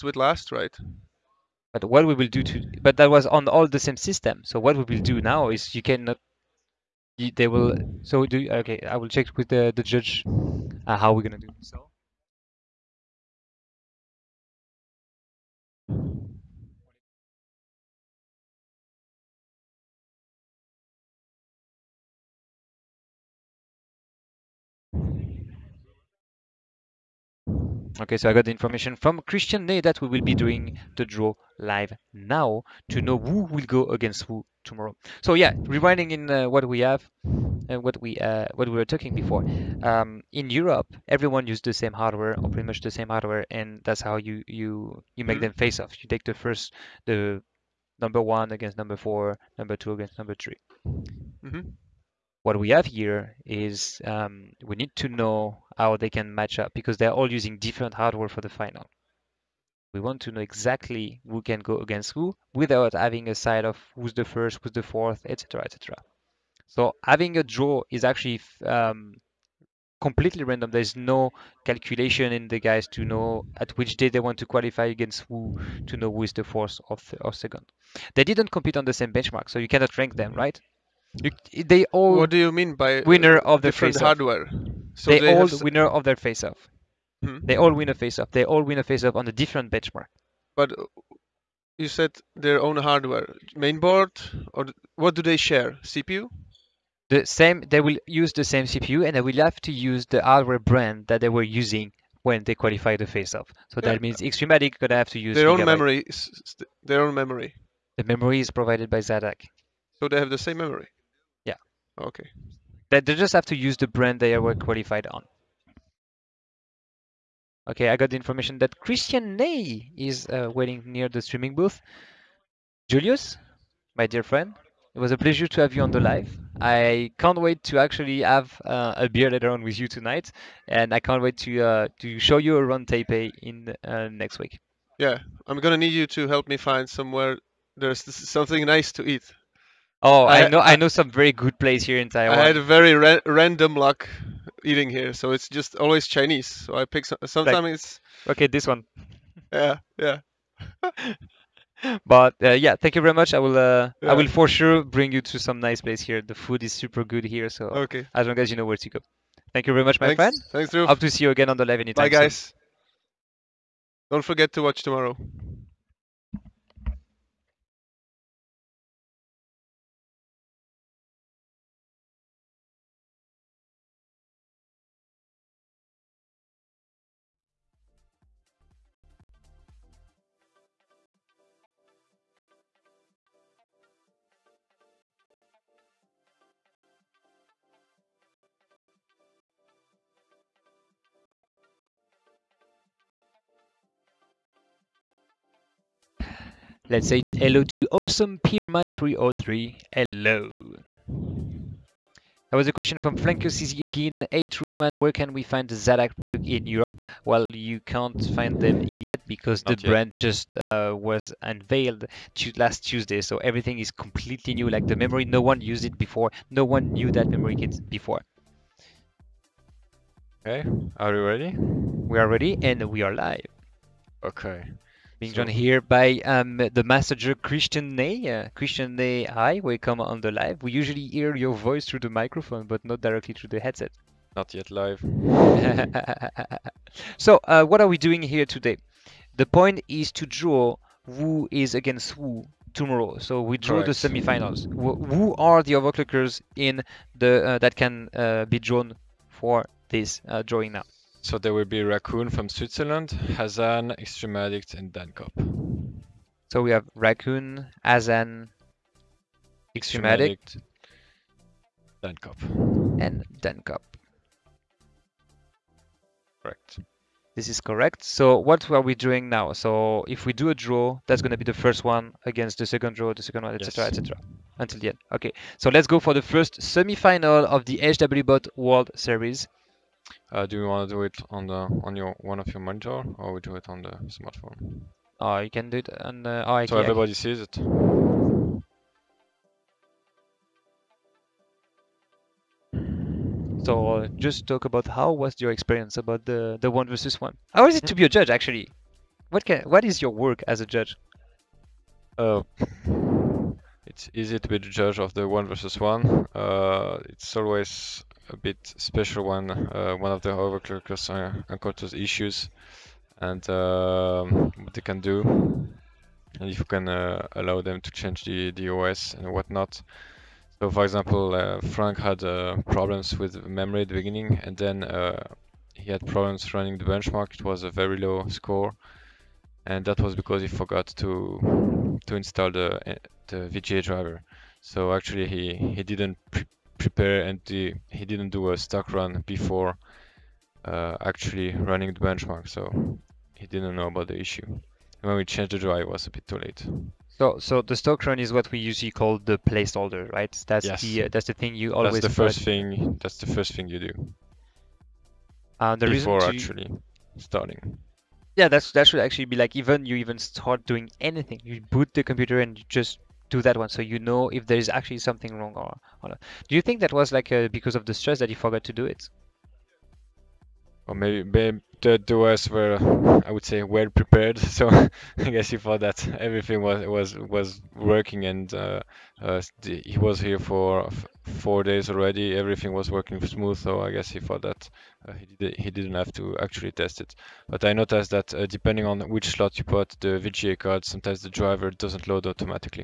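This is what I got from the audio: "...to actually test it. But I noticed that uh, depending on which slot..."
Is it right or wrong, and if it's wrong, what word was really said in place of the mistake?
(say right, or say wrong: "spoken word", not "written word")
right.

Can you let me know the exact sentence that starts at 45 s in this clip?
them face off you take the first the number one against number four number two against number 3 mm -hmm.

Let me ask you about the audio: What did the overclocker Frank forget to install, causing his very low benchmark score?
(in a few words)
VGA driver.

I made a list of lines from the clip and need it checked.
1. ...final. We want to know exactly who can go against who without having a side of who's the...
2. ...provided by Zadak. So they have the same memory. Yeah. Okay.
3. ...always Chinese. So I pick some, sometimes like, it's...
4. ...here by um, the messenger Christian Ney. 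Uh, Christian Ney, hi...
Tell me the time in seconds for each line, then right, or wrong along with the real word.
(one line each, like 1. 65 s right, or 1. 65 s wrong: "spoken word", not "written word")
1. 58 s right
2. 108 s right
3. 145 s right
4. 225 s right.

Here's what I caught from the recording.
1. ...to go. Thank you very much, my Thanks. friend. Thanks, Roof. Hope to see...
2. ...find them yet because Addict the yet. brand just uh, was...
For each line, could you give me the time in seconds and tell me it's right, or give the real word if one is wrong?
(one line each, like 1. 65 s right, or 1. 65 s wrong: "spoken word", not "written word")
1. 158 s right
2. 208 s wrong: "Not", not "Addict".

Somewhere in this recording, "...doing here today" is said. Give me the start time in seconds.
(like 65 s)
237 s.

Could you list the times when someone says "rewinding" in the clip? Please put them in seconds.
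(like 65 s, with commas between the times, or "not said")
35 s.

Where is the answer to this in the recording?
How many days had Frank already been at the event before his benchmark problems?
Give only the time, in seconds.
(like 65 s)
381 s.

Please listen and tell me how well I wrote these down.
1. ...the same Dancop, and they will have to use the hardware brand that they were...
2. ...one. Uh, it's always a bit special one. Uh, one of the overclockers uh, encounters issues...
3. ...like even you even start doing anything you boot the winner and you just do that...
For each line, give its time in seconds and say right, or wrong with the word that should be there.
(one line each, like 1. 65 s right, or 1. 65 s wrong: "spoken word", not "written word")
1. 98 s wrong: "CPU", not "Dancop"
2. 305 s right
3. 359 s wrong: "computer", not "winner".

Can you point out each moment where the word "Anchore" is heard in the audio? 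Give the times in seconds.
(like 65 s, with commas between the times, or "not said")
not said.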